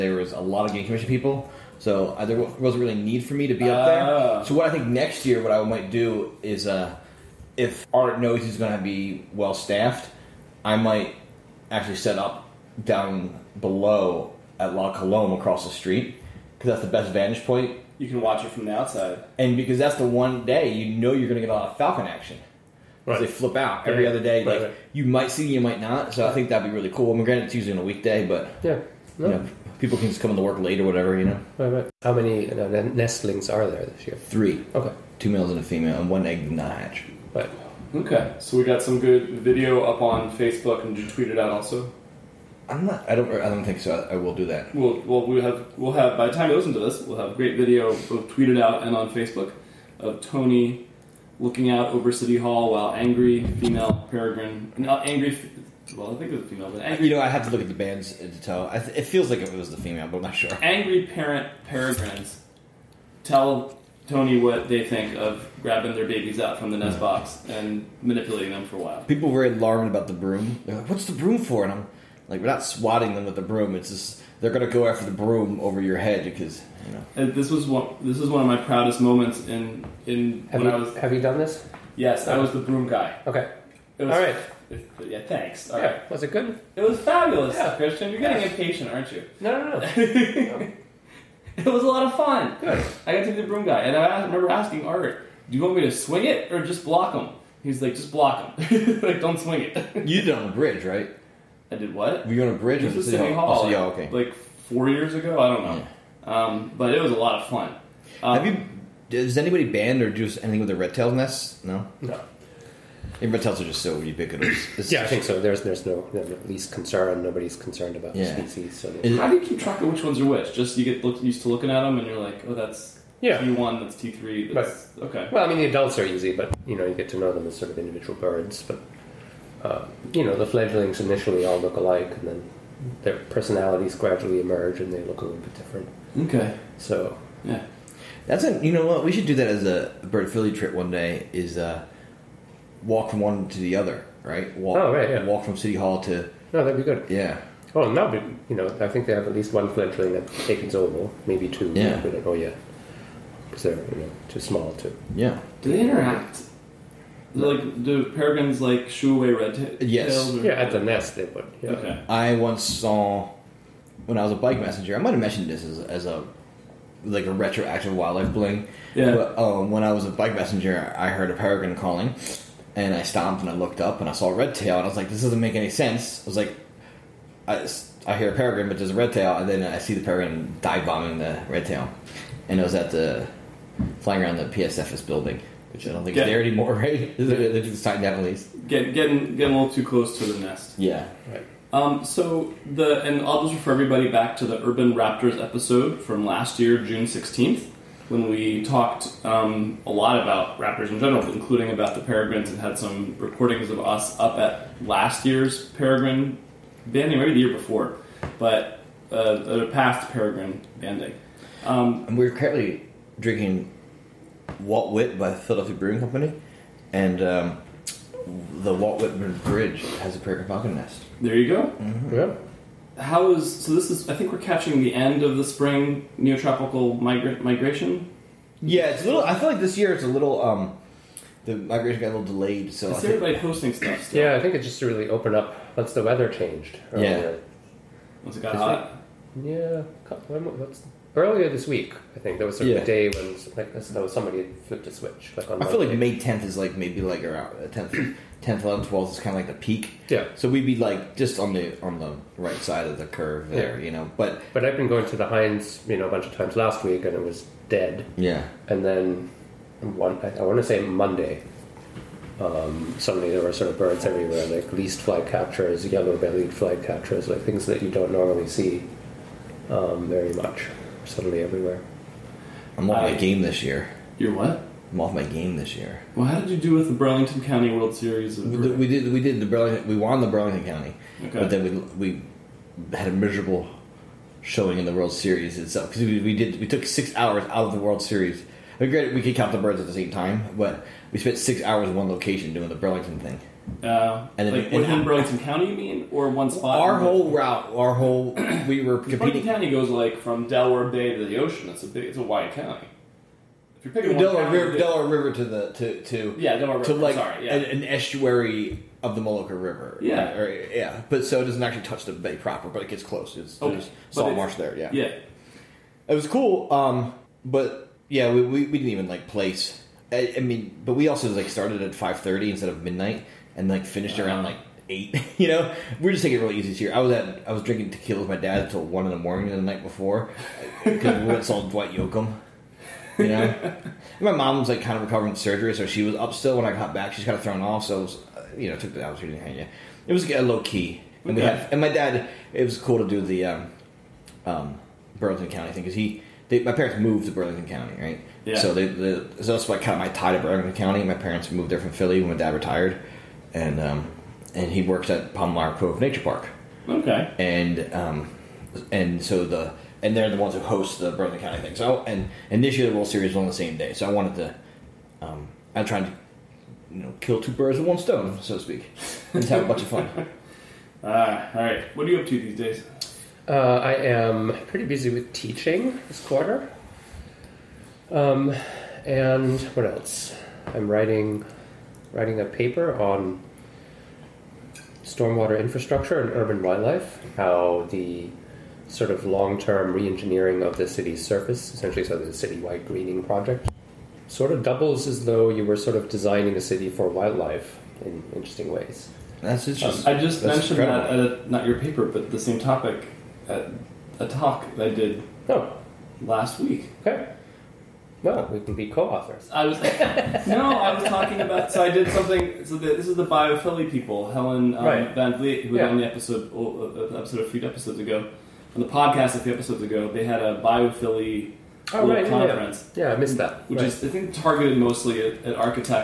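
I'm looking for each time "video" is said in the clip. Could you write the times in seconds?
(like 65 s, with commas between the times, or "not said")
39 s, 47 s.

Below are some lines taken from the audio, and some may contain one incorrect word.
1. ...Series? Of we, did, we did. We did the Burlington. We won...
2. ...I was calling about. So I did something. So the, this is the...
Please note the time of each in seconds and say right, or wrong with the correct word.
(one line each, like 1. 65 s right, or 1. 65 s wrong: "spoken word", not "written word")
1. 277 s right
2. 410 s wrong: "talking", not "calling".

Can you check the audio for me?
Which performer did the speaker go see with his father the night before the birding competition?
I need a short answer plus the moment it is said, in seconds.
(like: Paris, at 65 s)
Dwight Yoakam, at 331 s.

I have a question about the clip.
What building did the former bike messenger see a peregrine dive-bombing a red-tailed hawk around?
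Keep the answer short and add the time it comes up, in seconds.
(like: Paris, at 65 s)
PSFS building, at 184 s.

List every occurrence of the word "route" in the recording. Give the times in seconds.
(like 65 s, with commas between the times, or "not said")
297 s.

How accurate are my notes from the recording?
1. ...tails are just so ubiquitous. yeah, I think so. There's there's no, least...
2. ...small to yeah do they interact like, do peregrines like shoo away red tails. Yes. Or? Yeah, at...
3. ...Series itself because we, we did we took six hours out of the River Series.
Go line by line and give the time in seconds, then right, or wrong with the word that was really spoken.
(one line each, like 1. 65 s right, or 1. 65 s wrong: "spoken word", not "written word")
1. 113 s right
2. 154 s right
3. 285 s wrong: "World", not "River".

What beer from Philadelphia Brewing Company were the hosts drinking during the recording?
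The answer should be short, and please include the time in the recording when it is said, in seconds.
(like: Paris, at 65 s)
Walt Wit, at 214 s.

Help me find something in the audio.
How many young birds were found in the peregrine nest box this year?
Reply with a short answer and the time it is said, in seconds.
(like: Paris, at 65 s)
3, at 34 s.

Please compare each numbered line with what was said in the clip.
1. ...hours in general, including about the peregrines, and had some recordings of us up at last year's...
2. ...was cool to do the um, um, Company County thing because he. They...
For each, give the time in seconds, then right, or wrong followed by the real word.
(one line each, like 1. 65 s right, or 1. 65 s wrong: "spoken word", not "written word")
1. 200 s wrong: "raptors", not "hours"
2. 342 s wrong: "Burlington", not "Company".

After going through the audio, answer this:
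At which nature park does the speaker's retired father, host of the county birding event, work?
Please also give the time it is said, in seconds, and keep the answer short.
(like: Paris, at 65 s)
Palmyra Cove Nature Park, at 355 s.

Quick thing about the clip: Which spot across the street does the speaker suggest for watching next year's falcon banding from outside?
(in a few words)
La Colombe.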